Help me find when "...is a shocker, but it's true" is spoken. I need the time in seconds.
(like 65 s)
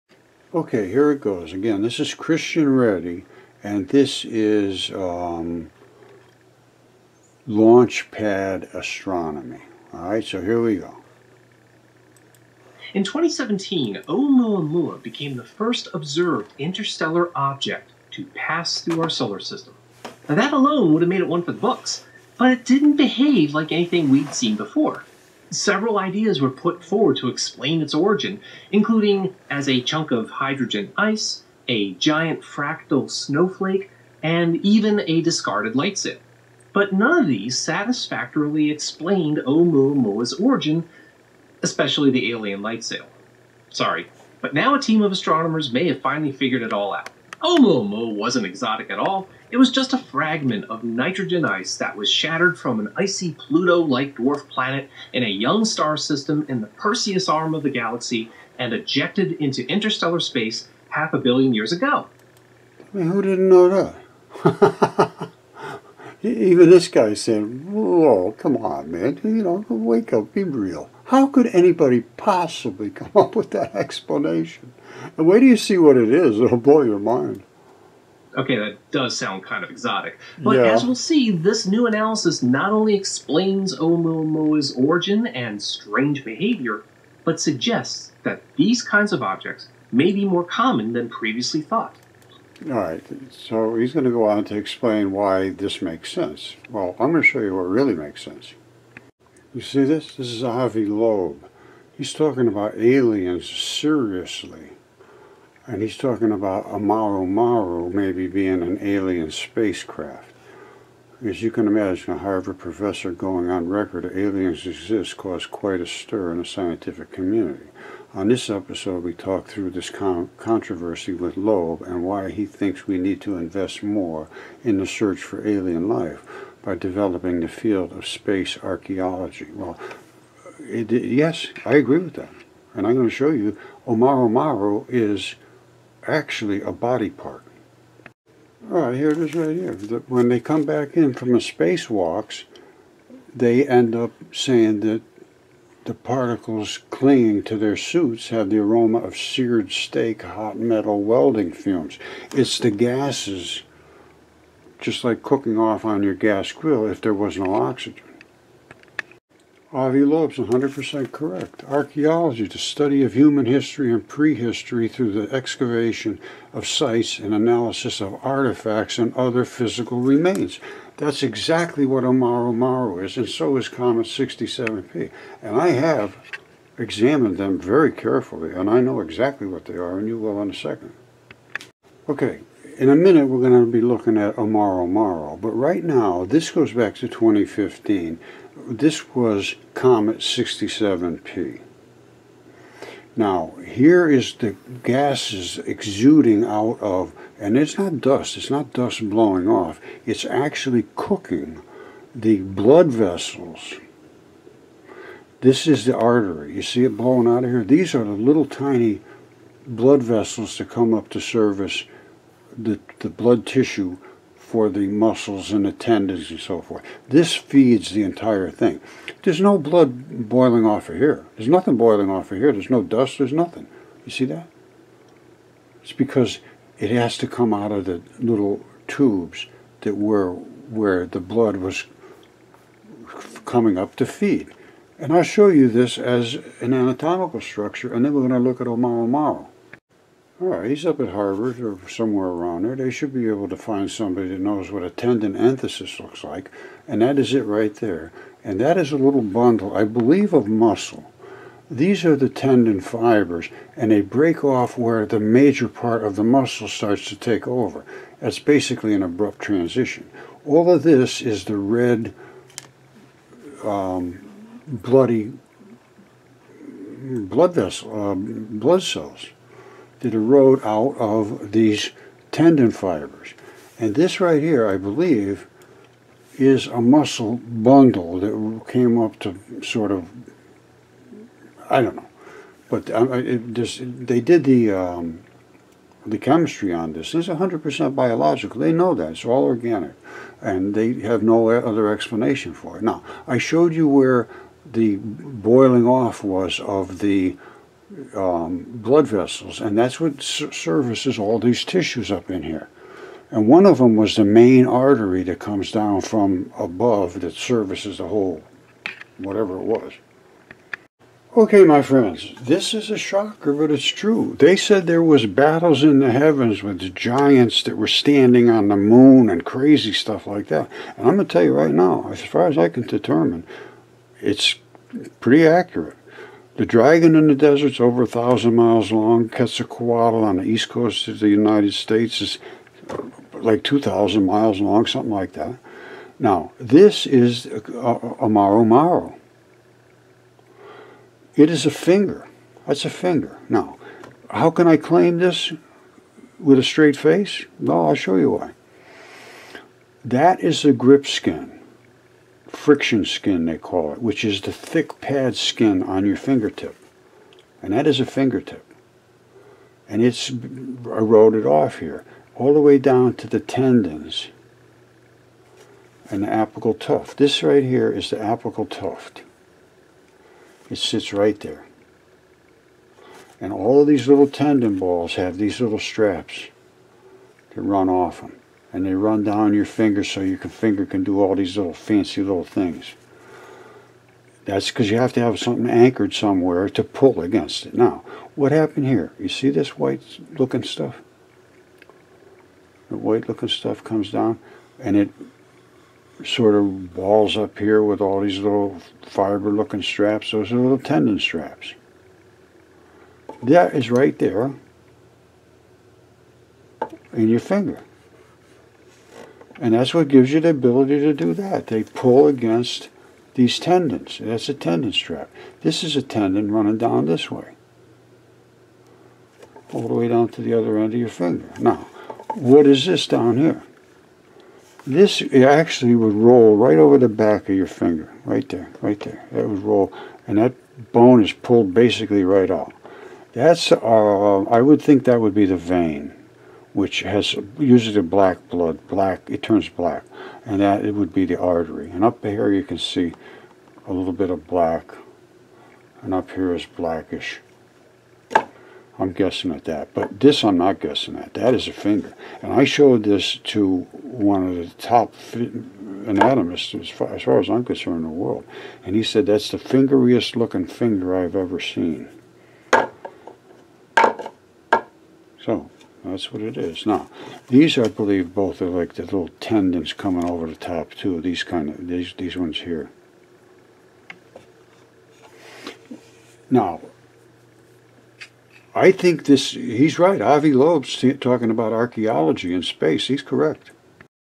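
312 s.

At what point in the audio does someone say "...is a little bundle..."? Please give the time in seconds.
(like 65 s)
248 s.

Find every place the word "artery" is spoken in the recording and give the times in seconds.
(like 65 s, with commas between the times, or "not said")
205 s, 304 s, 441 s.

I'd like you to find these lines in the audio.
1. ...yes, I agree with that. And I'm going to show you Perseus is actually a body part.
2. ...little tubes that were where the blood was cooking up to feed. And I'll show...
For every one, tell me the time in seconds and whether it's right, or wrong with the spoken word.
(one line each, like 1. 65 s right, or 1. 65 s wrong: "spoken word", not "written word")
1. 130 s wrong: "Omaru", not "Perseus"
2. 228 s wrong: "coming", not "cooking".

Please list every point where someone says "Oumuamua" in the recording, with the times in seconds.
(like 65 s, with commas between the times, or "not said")
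14 s, 39 s, 47 s, 83 s.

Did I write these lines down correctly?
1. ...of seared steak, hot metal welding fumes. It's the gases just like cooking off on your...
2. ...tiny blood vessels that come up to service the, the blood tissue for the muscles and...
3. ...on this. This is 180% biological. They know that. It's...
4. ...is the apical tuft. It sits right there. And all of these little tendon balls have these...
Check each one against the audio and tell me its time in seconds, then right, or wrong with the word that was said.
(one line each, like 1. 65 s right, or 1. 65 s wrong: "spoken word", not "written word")
1. 148 s right
2. 208 s right
3. 286 s wrong: "100", not "180"
4. 367 s right.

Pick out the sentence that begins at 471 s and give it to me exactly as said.
These kind of these these ones here.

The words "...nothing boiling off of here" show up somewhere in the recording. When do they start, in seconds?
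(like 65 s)
221 s.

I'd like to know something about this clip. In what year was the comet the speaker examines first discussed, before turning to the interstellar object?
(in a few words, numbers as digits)
2015.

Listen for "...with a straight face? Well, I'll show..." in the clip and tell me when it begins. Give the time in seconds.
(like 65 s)
346 s.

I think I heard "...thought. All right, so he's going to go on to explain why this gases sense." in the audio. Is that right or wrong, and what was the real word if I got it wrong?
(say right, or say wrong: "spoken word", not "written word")
wrong: "makes", not "gases".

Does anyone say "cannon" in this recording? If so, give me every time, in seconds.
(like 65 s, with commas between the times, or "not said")
not said.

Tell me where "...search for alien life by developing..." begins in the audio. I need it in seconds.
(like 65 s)
124 s.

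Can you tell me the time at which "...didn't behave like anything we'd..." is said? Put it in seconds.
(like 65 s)
22 s.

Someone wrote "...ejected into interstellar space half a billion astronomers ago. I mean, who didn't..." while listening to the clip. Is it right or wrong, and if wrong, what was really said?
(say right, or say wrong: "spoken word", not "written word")
wrong: "years", not "astronomers".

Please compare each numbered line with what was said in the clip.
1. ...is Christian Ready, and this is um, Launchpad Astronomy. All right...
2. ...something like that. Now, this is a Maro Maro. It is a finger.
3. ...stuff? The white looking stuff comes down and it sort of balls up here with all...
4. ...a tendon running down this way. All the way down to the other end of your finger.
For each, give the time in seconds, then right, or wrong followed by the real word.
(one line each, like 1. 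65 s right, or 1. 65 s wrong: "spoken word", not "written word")
1. 1 s right
2. 334 s right
3. 390 s right
4. 415 s right.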